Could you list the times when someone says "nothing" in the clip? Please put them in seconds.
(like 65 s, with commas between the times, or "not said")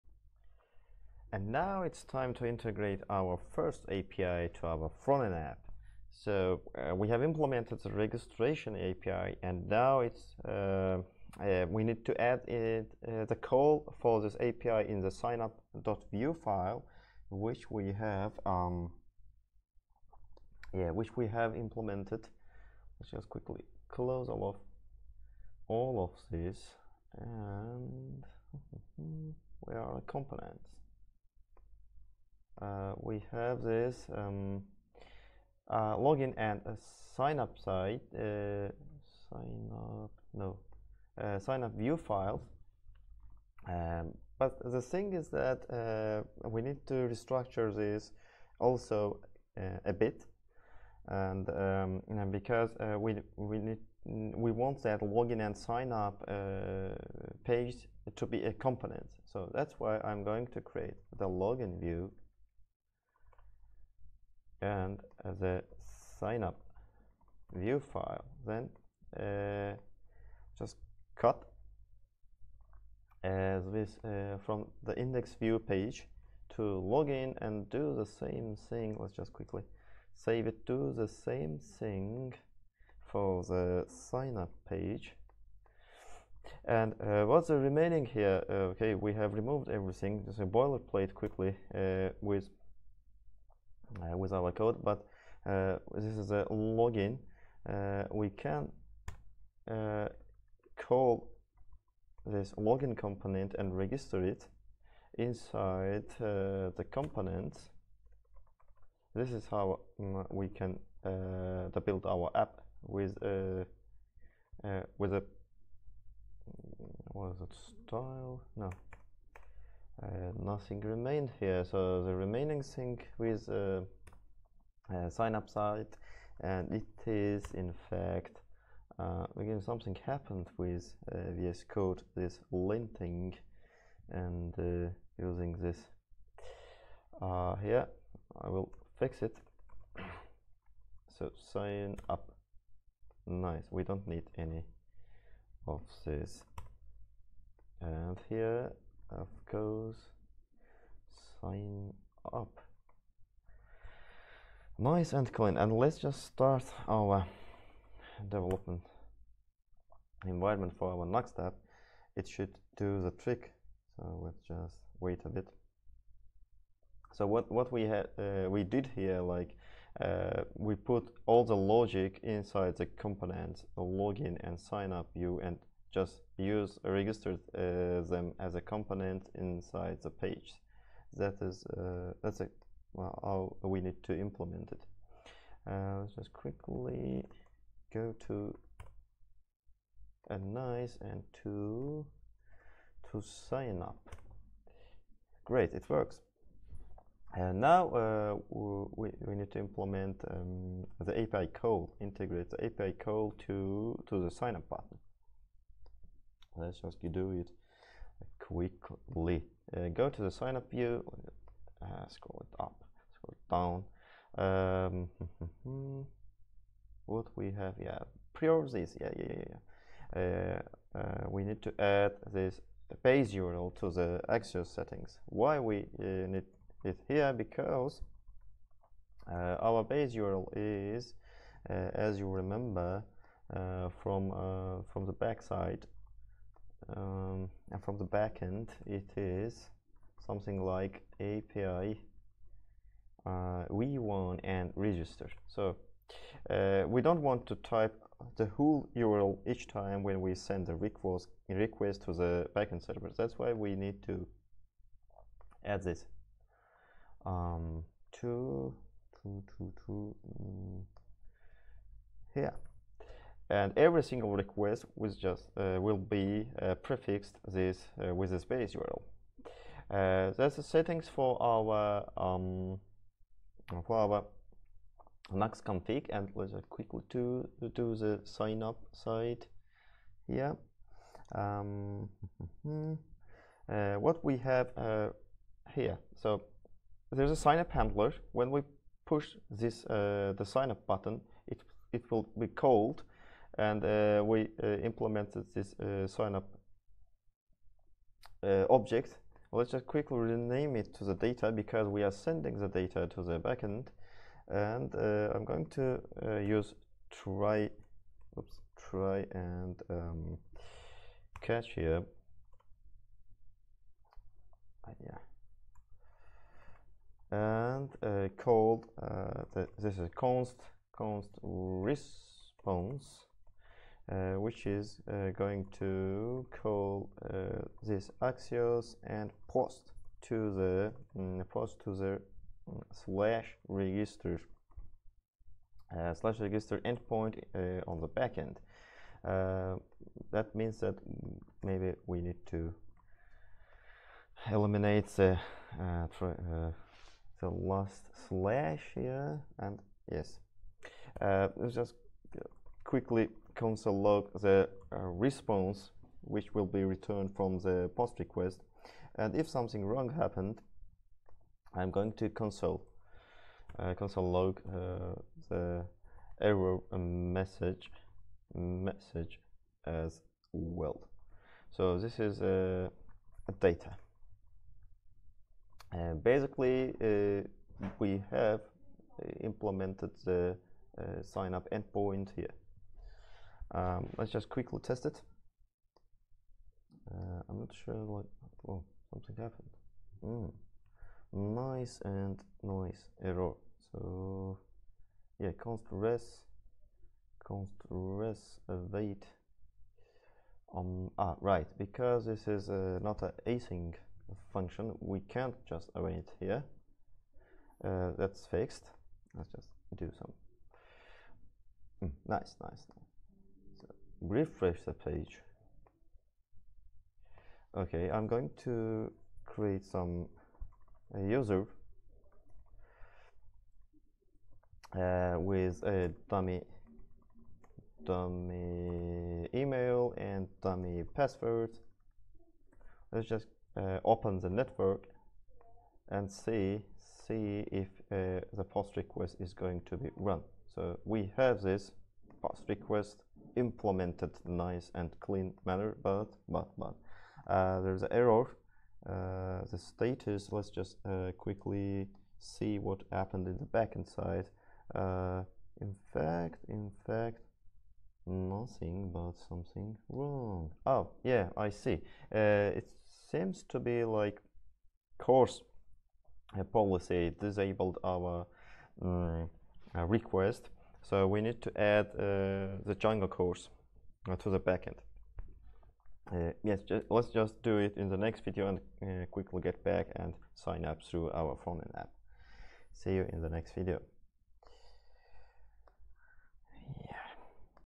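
120 s, 458 s.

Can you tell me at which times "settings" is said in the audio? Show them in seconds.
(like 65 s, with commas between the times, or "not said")
224 s, 270 s.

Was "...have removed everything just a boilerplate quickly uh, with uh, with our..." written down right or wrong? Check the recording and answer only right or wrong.
right.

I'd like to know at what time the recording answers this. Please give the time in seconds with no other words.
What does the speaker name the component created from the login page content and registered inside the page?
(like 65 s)
102 s.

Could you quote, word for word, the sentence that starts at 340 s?
that means that maybe we need to eliminate the the last slash here and yes.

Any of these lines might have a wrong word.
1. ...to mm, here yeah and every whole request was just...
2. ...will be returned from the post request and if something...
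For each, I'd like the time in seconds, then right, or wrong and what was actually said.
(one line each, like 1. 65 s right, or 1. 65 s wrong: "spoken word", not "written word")
1. 259 s wrong: "single", not "whole"
2. 356 s right.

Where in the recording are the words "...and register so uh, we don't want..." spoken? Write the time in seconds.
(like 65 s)
244 s.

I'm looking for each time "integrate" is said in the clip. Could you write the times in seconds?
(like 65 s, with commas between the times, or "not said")
2 s, 202 s.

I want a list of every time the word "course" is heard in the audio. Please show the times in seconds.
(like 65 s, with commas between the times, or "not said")
149 s.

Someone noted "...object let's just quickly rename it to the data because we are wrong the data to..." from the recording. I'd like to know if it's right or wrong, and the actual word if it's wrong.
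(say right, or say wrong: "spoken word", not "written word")
wrong: "sending", not "wrong".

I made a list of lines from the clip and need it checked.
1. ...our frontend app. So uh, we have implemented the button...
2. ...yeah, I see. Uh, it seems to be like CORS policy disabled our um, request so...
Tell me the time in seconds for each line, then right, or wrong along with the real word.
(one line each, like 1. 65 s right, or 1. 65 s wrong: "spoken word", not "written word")
1. 4 s wrong: "registration", not "button"
2. 461 s right.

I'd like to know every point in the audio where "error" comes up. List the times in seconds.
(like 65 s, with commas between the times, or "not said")
366 s, 393 s, 448 s.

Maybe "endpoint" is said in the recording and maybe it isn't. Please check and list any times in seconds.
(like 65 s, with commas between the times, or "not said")
336 s, 381 s.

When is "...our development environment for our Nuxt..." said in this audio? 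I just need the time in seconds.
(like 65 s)
156 s.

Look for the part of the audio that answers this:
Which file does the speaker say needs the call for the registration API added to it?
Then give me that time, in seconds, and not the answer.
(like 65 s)
15 s.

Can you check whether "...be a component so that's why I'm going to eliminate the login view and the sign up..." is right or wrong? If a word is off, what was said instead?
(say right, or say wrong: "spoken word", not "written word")
wrong: "create", not "eliminate".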